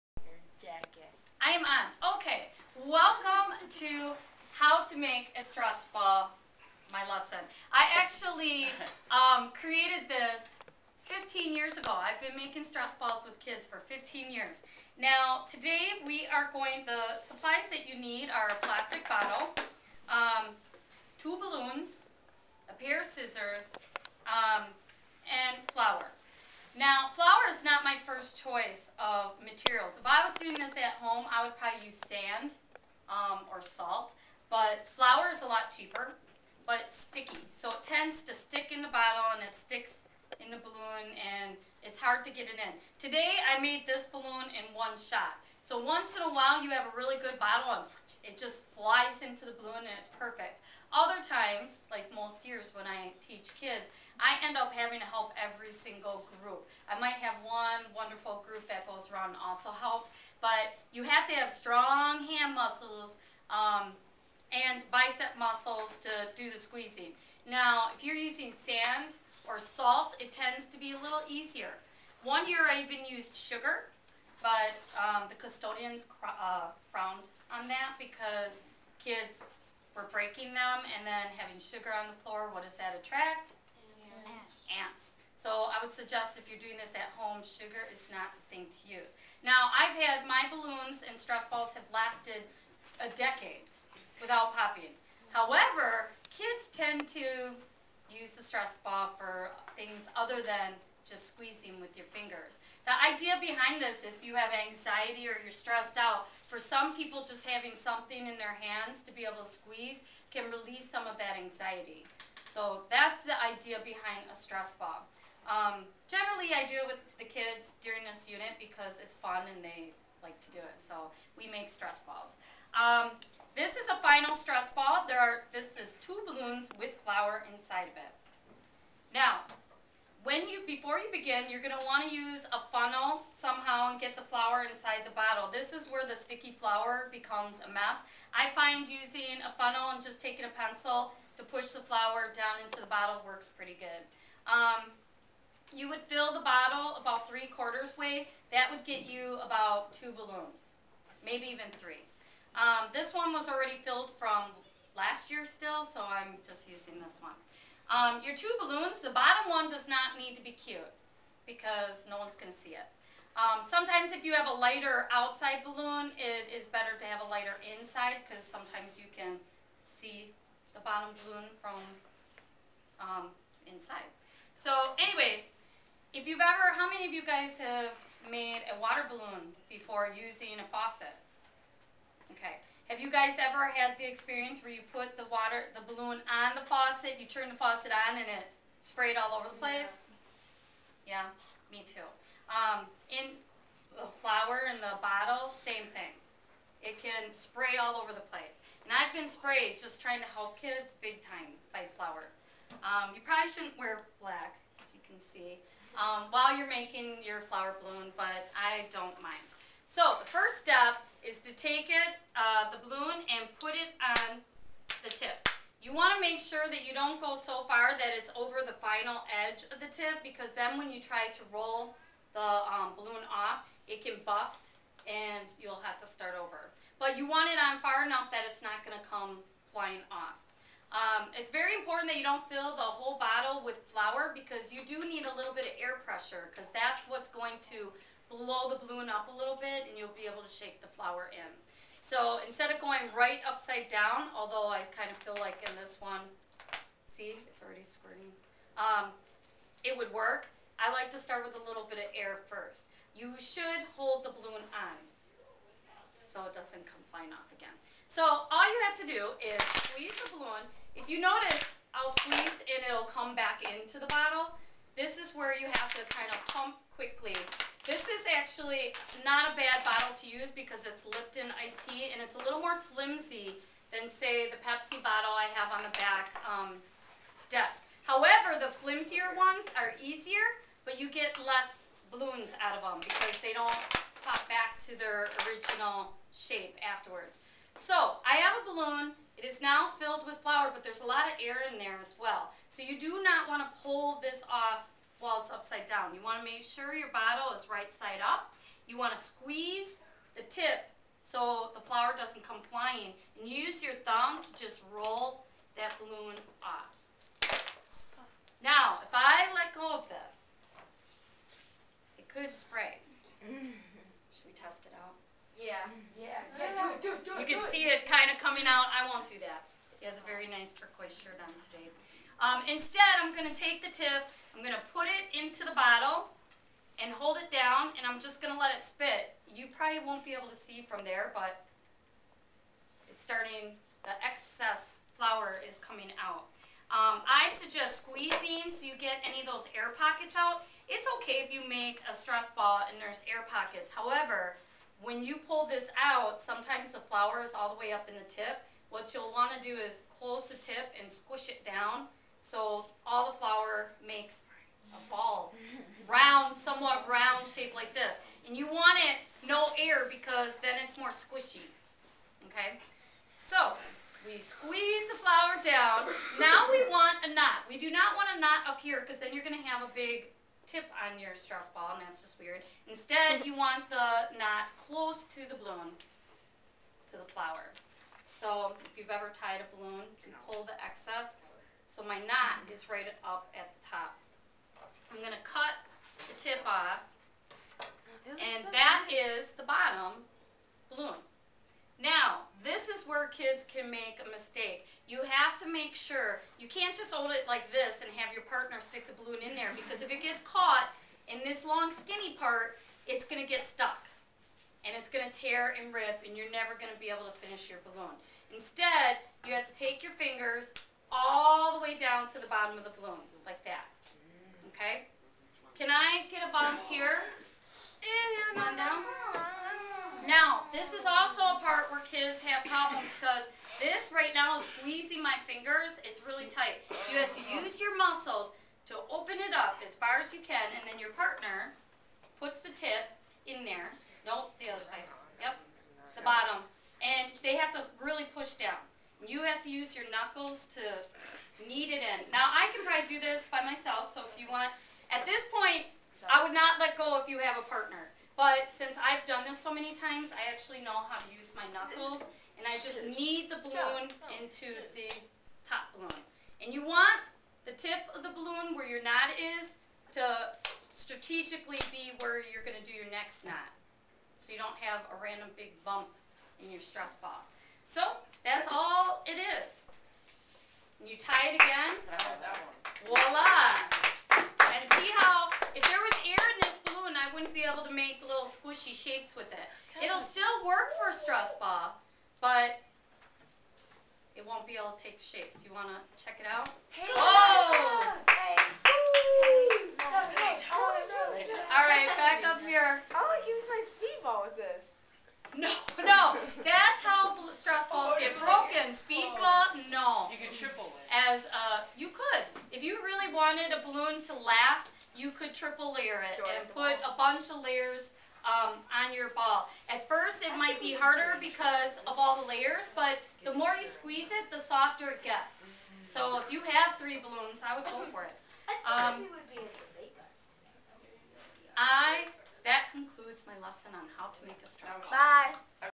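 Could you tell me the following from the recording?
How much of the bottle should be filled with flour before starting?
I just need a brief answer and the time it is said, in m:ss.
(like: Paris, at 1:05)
three quarters, at 2:27.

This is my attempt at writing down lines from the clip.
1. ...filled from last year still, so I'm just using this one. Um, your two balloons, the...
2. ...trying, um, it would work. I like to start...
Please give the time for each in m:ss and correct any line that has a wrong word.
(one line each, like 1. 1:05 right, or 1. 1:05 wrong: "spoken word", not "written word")
1. 2:33 right
2. 4:07 wrong: "squirting", not "trying".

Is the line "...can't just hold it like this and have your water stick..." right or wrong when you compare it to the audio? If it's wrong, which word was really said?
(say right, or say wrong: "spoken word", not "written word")
wrong: "partner", not "water".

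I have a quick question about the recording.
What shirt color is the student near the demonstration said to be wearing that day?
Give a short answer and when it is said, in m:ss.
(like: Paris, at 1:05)
turquoise, at 5:20.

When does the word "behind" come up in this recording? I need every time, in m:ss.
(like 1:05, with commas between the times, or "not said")
1:43, 1:53.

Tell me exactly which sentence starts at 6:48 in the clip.
Instead, you have to take your fingers way down to the bottom of the balloon, like that.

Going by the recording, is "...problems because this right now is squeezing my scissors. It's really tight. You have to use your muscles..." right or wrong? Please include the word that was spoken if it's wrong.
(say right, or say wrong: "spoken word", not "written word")
wrong: "fingers", not "scissors".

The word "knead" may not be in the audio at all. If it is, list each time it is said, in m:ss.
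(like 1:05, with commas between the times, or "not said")
7:21, 7:33.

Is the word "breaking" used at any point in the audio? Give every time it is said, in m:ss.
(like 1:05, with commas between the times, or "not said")
1:20.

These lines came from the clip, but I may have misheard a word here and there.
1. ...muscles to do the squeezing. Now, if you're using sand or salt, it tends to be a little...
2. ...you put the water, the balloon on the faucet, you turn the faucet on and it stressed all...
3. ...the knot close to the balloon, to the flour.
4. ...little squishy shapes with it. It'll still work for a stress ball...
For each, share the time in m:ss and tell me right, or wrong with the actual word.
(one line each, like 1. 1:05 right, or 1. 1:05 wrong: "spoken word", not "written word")
1. 1:05 right
2. 3:04 wrong: "sprayed", not "stressed"
3. 6:13 right
4. 7:58 right.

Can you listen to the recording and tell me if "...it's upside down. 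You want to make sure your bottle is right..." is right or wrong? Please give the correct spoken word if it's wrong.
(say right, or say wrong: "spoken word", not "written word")
right.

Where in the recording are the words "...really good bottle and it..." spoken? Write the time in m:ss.
0:46.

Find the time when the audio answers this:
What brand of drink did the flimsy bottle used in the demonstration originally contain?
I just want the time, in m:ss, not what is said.
4:31.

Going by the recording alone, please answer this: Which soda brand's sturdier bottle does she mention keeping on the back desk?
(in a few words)
Pepsi.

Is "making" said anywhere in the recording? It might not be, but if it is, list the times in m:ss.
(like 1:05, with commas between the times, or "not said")
0:12, 3:26.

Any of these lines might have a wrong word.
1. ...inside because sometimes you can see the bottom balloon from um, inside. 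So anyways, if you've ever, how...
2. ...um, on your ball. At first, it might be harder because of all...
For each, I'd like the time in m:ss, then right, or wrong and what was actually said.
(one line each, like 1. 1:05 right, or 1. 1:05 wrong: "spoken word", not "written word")
1. 2:47 right
2. 8:28 right.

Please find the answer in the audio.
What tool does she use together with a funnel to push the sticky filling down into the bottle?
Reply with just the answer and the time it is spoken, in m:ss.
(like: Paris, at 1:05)
a pencil, at 2:20.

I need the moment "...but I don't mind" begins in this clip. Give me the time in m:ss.
3:28.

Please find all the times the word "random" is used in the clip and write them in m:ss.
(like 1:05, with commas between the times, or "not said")
7:45.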